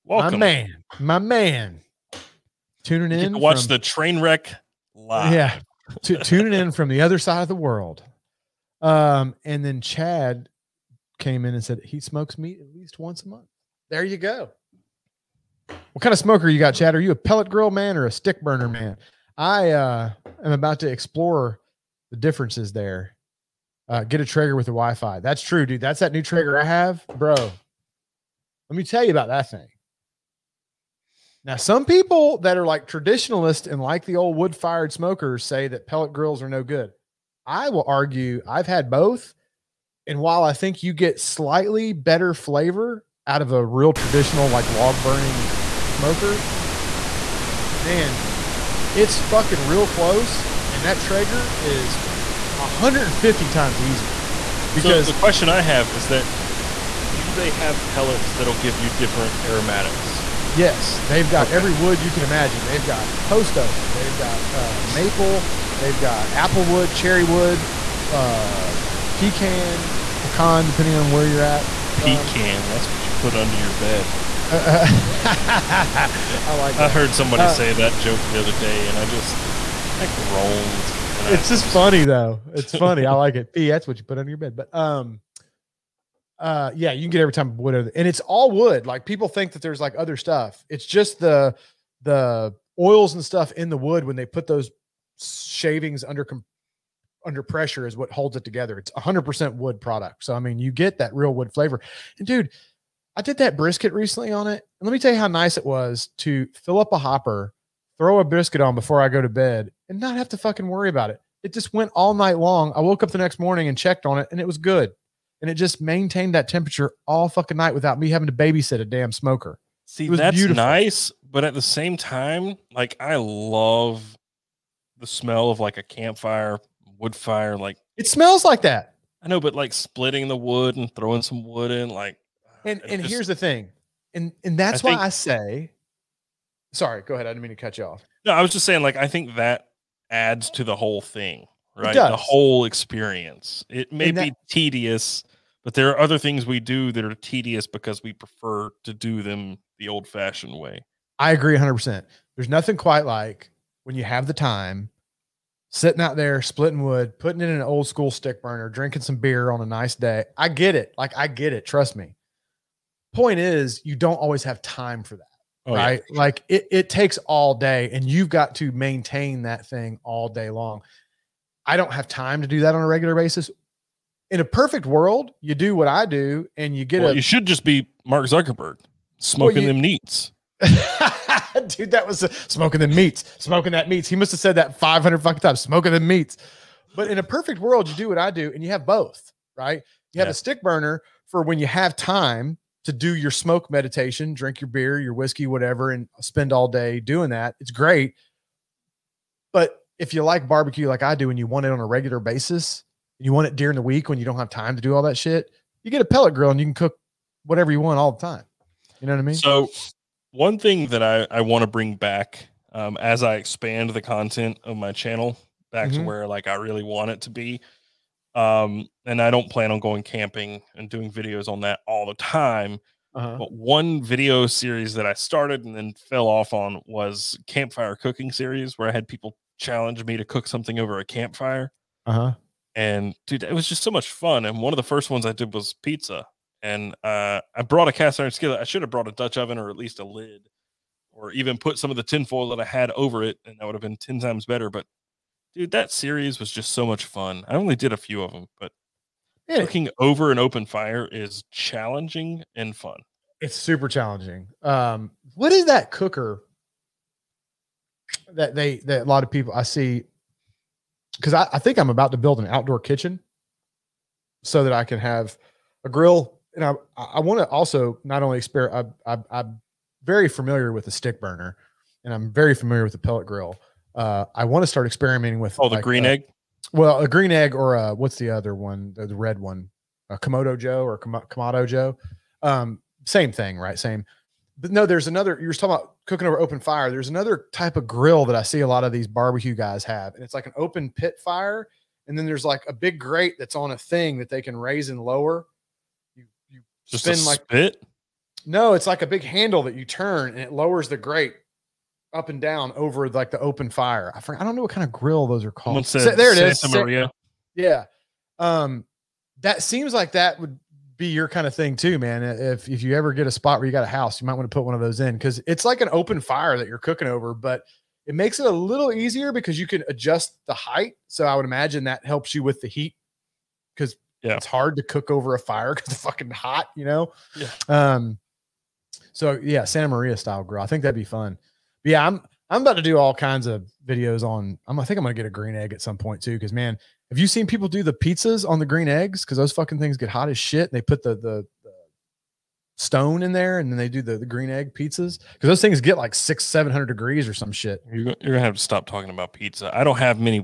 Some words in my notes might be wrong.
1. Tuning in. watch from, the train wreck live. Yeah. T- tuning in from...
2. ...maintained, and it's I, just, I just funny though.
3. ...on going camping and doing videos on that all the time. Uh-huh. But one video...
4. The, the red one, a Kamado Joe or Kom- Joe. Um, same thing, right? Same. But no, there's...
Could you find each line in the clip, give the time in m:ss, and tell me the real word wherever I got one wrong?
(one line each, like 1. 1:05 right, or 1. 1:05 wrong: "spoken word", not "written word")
1. 0:02 right
2. 1:20 wrong: "groaned", not "maintained"
3. 3:39 right
4. 4:38 right.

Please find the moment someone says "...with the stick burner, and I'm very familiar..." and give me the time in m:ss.
4:30.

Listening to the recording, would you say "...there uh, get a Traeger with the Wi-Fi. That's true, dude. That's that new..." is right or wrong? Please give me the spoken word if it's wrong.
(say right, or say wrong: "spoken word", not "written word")
right.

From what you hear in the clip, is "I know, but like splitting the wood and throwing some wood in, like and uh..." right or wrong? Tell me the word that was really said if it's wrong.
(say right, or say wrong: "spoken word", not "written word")
right.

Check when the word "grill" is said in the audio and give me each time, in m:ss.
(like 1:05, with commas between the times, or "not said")
0:17, 0:36, 3:26, 4:25, 4:33, 4:47, 5:04, 5:30.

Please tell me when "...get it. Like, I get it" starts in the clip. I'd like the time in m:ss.
2:40.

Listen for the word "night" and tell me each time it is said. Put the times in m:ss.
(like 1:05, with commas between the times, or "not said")
1:52, 1:57.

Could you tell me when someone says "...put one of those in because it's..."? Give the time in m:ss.
5:14.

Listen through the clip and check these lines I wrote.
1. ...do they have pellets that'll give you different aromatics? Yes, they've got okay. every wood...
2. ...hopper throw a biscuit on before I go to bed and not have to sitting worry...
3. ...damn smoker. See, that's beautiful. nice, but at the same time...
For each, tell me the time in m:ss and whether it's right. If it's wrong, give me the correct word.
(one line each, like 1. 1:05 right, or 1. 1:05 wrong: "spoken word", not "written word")
1. 0:57 right
2. 1:46 wrong: "fucking", not "sitting"
3. 1:58 right.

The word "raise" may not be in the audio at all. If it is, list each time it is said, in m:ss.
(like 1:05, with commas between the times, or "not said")
4:54.